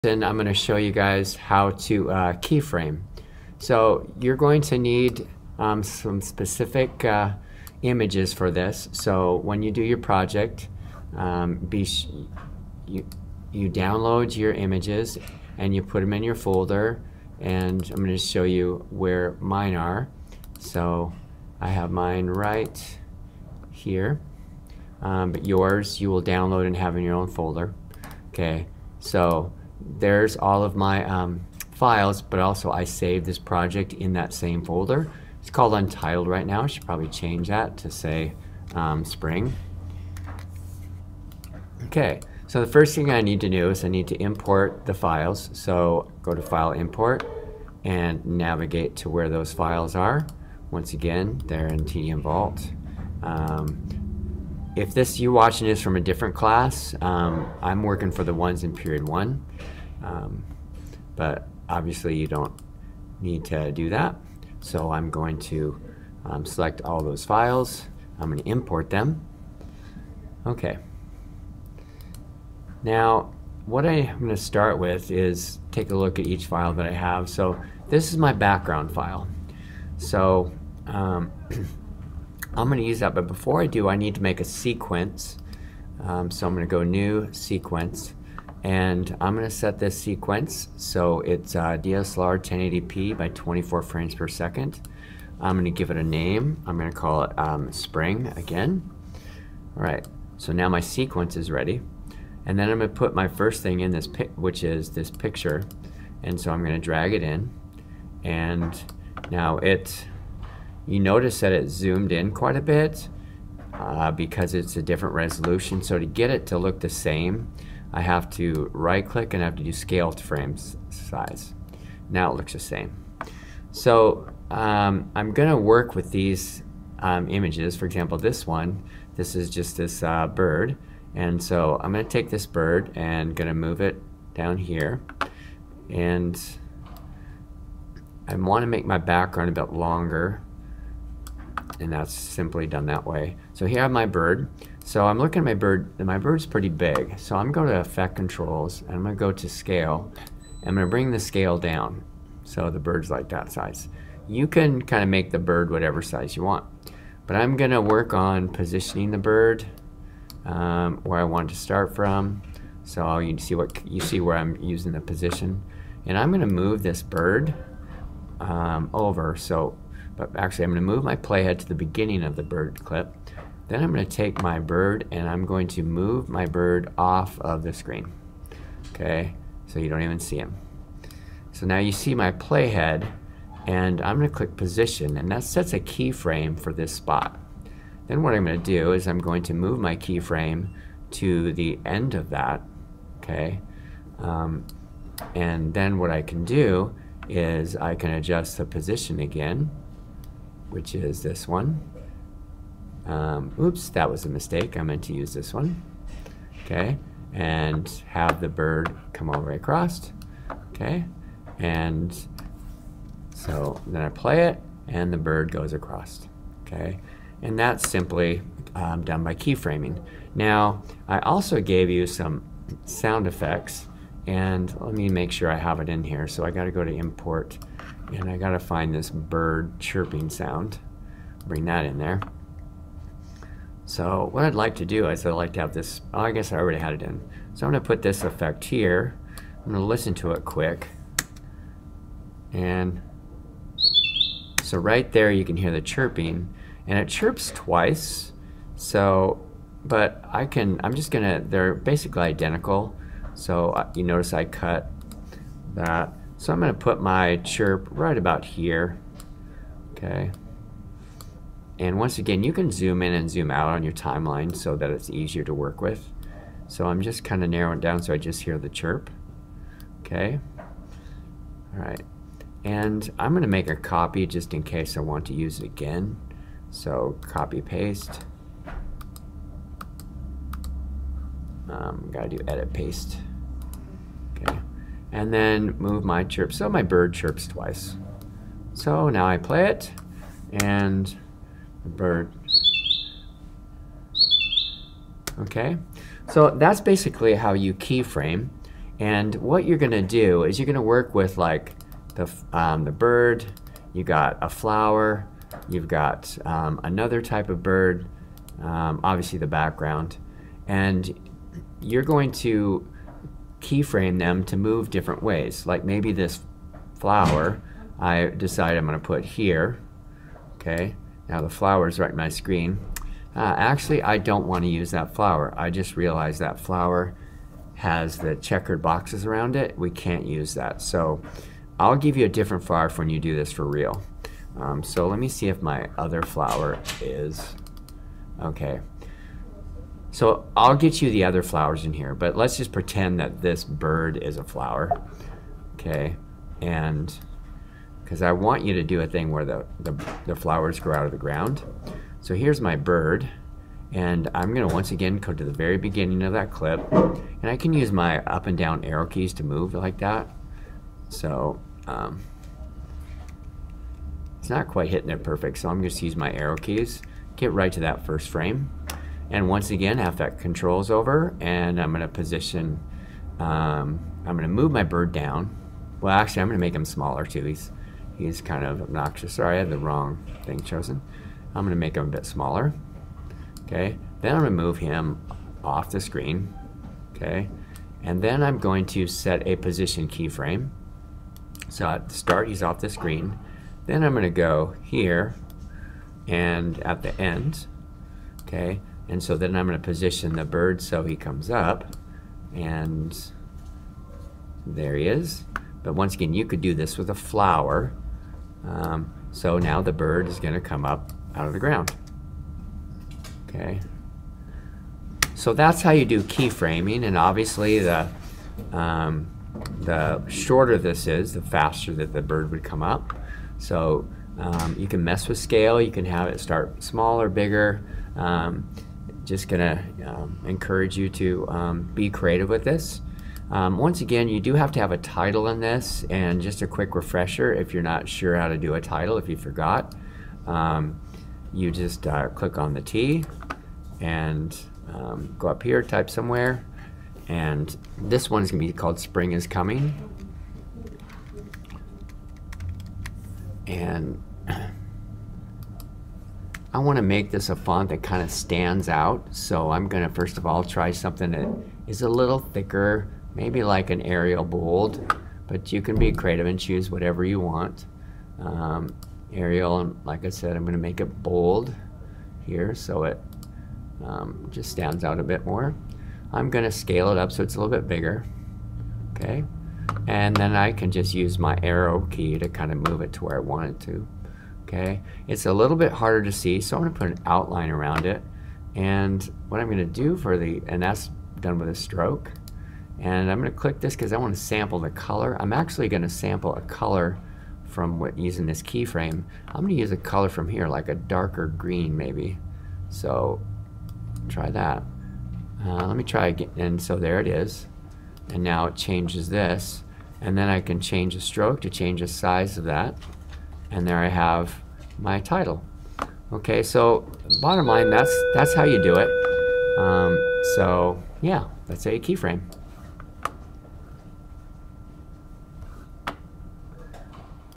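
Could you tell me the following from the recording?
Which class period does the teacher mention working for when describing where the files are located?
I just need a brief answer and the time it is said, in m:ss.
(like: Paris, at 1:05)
period one, at 0:58.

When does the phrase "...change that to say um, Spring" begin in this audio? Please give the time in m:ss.
0:37.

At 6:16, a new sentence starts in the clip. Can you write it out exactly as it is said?
Well, actually, I'm gonna make him smaller too.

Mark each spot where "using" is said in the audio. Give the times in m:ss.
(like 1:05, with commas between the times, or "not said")
2:44, 8:18.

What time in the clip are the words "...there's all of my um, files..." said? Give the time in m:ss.
0:29.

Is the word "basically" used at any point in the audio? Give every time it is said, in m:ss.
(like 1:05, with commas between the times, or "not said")
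4:11, 4:56.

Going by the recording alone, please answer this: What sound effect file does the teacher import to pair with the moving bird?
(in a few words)
bird chirping.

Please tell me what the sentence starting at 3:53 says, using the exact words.
So what I'd like to do is I'd like to have this, oh, I guess I already had it in.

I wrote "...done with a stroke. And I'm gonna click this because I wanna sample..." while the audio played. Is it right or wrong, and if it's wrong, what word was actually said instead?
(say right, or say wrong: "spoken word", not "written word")
right.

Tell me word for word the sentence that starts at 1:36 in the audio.
I'm gonna call it um, spring again.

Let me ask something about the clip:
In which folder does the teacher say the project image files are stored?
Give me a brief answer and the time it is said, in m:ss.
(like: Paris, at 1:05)
TDM Vault, at 0:51.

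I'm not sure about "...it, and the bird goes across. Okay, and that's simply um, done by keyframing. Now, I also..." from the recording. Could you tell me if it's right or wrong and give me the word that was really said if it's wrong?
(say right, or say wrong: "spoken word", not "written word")
right.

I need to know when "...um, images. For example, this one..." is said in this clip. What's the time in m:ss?
2:06.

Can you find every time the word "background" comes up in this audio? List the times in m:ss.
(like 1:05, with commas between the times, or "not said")
1:18, 2:18, 5:09.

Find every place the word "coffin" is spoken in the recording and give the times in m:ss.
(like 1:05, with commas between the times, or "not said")
not said.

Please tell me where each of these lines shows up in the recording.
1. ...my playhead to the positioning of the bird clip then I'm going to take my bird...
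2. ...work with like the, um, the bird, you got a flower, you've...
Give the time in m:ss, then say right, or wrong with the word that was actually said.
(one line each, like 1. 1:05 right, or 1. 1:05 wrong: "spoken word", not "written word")
1. 2:51 wrong: "beginning", not "positioning"
2. 5:00 right.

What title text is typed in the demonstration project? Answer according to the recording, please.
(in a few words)
Spring is Coming.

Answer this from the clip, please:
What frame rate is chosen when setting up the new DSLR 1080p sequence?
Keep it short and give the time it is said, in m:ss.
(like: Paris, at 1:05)
24 frames per second, at 1:33.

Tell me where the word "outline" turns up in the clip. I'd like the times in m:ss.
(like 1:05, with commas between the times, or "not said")
8:07.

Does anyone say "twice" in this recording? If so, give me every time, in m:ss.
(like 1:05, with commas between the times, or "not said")
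4:07, 4:47.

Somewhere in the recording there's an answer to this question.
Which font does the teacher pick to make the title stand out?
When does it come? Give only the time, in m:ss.
7:44.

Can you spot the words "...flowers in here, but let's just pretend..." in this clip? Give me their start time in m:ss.
5:41.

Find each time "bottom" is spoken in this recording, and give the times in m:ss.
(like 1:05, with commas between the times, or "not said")
8:37.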